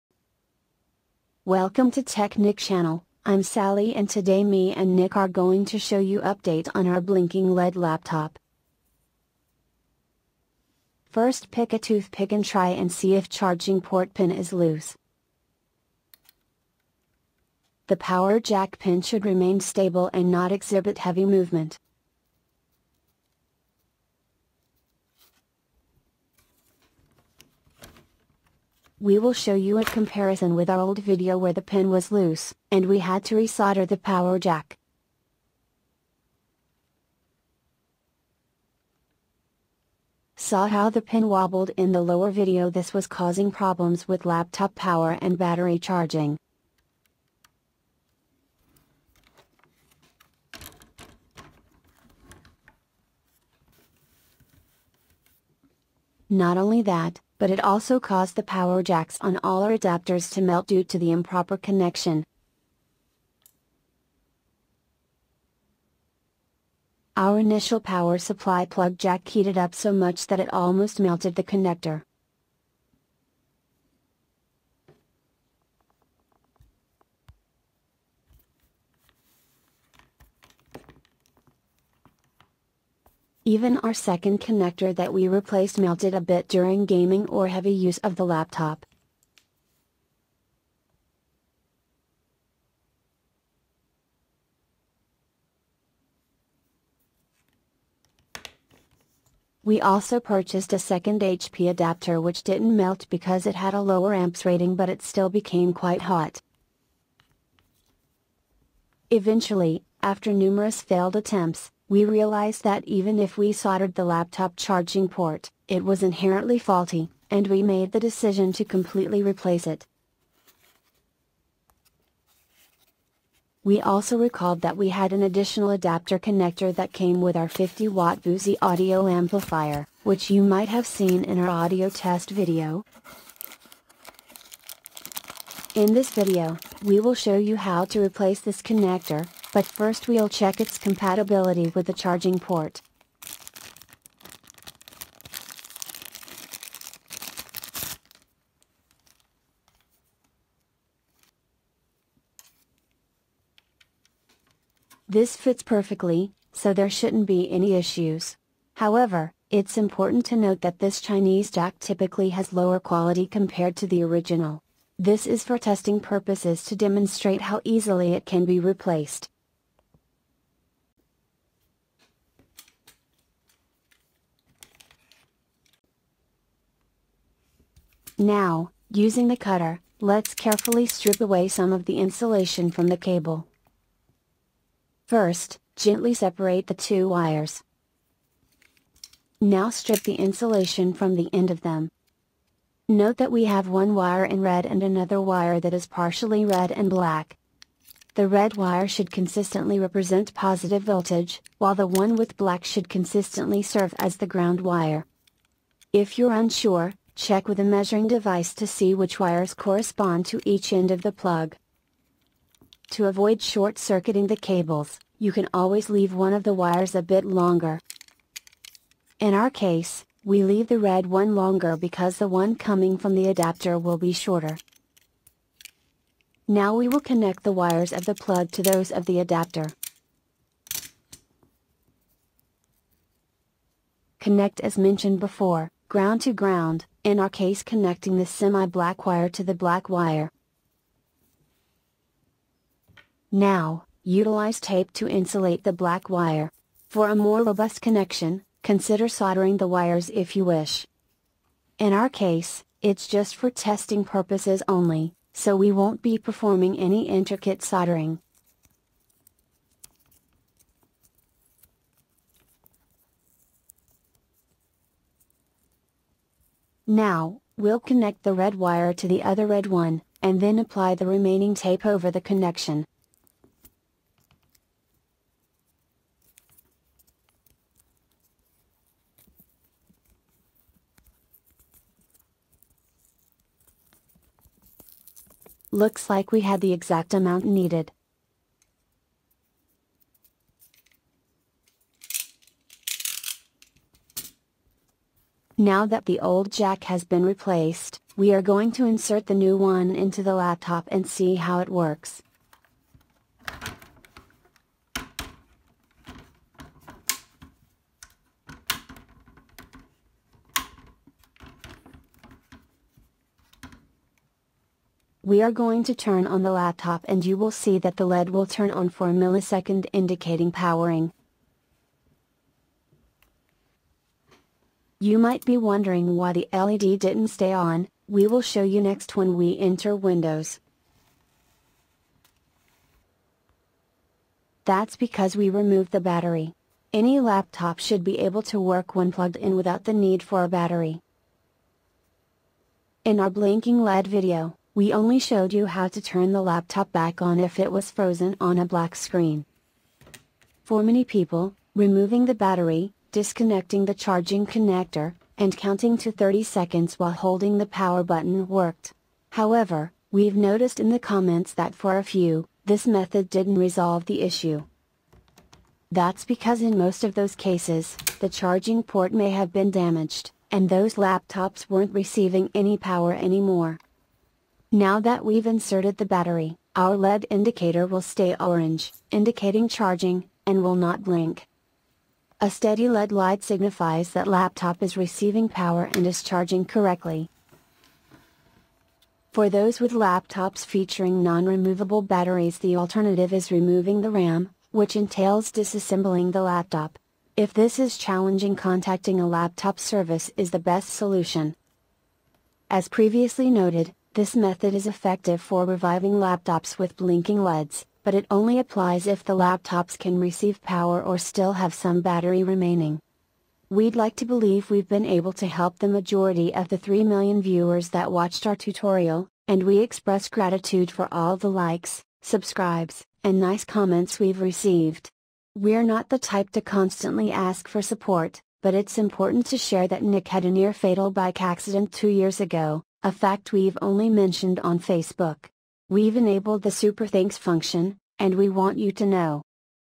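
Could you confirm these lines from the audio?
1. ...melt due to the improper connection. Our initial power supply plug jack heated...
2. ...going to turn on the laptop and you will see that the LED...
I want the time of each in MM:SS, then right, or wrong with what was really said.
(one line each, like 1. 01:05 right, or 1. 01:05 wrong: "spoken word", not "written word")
1. 01:00 right
2. 05:15 right.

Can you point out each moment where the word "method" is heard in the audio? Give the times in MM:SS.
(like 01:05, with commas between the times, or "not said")
06:02, 06:44.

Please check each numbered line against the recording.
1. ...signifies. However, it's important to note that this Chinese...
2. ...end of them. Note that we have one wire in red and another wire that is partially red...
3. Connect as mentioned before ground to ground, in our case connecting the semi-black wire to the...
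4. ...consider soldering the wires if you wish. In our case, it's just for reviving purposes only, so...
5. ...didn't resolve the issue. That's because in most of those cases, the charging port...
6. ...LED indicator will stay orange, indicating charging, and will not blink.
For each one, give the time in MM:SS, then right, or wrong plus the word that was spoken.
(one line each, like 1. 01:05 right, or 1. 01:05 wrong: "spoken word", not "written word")
1. 02:37 wrong: "issues", not "signifies"
2. 03:11 right
3. 03:54 right
4. 04:08 wrong: "testing", not "reviving"
5. 06:03 right
6. 06:16 right.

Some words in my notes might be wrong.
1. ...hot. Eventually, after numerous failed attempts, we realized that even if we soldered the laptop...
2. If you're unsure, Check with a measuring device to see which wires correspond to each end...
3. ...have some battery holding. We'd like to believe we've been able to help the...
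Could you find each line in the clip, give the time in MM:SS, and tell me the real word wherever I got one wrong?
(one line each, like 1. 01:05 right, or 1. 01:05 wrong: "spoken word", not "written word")
1. 01:46 right
2. 03:25 right
3. 06:51 wrong: "remaining", not "holding".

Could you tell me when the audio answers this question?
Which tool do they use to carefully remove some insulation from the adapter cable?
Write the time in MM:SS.
02:59.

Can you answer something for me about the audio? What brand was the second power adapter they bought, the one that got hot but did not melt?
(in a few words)
HP.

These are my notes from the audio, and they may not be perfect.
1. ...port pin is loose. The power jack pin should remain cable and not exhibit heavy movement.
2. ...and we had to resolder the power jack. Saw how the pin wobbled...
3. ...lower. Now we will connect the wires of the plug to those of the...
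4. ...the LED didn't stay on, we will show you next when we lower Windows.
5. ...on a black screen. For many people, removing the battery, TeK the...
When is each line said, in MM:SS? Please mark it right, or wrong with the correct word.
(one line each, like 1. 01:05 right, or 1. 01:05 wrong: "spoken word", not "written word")
1. 00:13 wrong: "stable", not "cable"
2. 00:32 right
3. 03:44 wrong: "shorter", not "lower"
4. 05:26 wrong: "enter", not "lower"
5. 05:48 wrong: "Disconnecting", not "TeK".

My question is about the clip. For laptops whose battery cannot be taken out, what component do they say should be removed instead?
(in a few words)
RAM.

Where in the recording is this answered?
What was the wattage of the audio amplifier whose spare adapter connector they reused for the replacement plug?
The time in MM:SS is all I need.
02:07.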